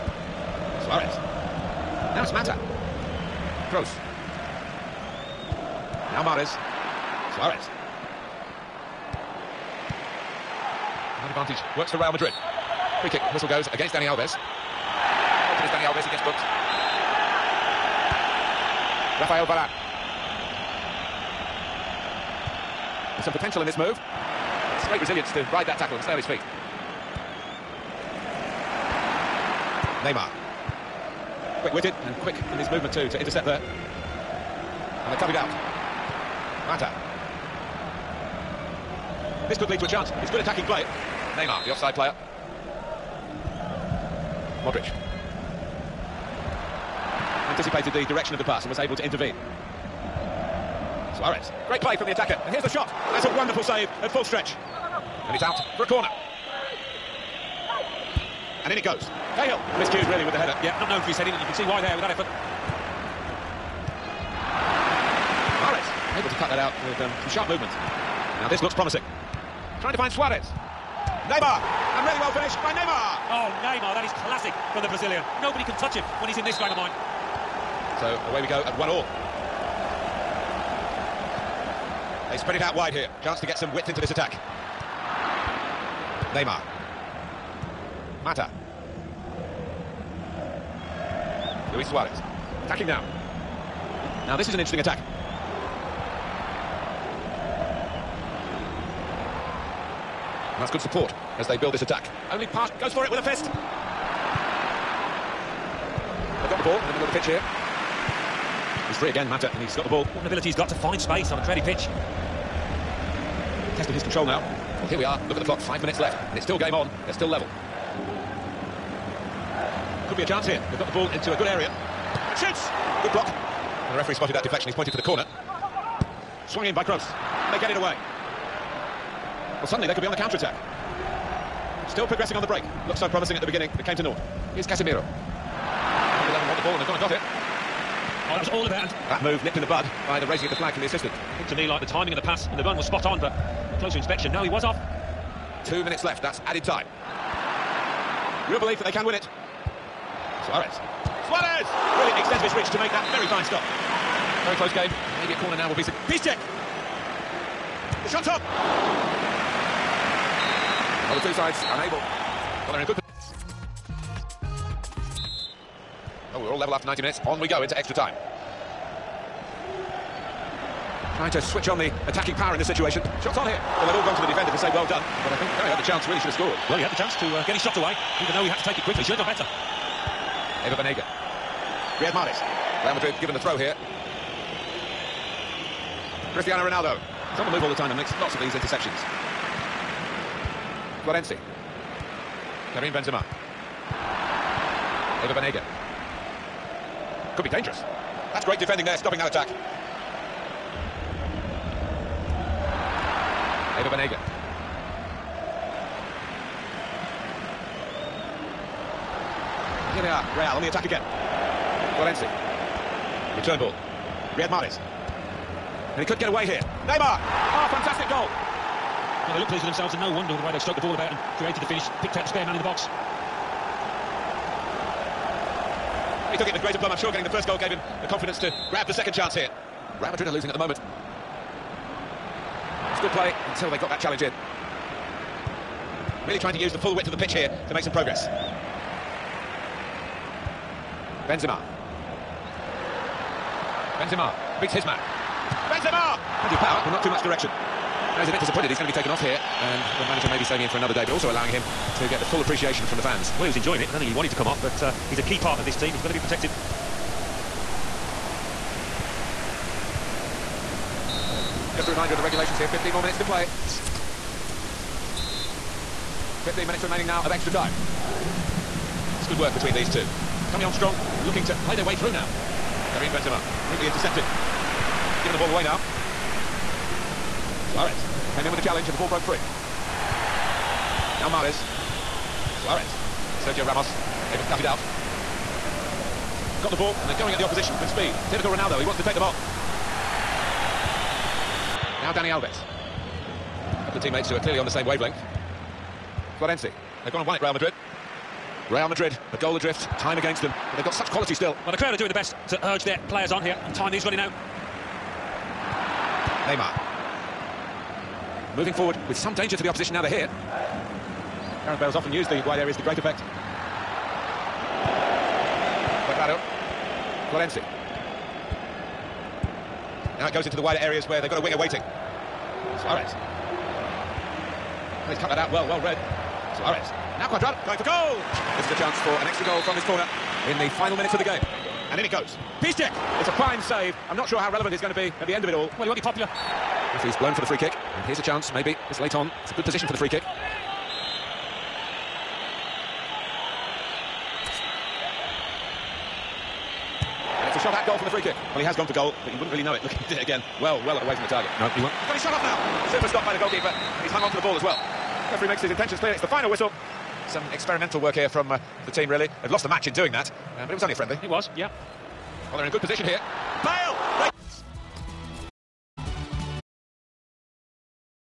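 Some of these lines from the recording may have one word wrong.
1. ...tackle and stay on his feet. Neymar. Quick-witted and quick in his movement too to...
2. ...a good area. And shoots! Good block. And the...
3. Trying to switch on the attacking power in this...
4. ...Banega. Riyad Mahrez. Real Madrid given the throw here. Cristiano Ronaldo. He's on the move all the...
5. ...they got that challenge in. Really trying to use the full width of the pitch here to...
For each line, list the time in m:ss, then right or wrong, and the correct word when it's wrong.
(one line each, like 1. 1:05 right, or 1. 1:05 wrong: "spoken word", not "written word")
1. 0:25 right
2. 2:01 right
3. 2:51 right
4. 3:00 right
5. 3:53 right.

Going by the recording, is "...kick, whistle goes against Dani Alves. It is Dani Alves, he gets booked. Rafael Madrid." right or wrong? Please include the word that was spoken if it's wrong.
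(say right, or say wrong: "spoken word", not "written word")
wrong: "Varane", not "Madrid".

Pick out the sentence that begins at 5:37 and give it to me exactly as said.
And here's a chance, maybe, this late on.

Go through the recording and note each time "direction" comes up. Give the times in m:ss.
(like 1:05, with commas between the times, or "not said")
0:48, 4:07.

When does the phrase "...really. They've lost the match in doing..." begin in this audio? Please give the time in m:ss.
5:59.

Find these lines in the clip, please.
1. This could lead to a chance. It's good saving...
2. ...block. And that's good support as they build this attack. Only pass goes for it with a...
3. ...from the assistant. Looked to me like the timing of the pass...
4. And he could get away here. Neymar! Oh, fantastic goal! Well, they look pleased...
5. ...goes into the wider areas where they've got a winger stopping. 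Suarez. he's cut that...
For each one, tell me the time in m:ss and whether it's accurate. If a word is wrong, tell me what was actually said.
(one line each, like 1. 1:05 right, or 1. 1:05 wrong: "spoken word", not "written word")
1. 0:39 wrong: "attacking", not "saving"
2. 1:34 wrong: "attack", not "block"
3. 2:20 right
4. 3:35 right
5. 5:20 wrong: "waiting", not "stopping".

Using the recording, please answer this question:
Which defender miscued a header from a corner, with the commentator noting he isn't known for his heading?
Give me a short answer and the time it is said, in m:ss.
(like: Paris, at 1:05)
Cahill, at 0:59.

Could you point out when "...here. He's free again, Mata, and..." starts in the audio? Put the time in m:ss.
1:47.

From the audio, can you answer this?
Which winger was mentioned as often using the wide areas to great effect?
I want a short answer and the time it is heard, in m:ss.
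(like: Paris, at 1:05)
Gareth Bale, at 5:11.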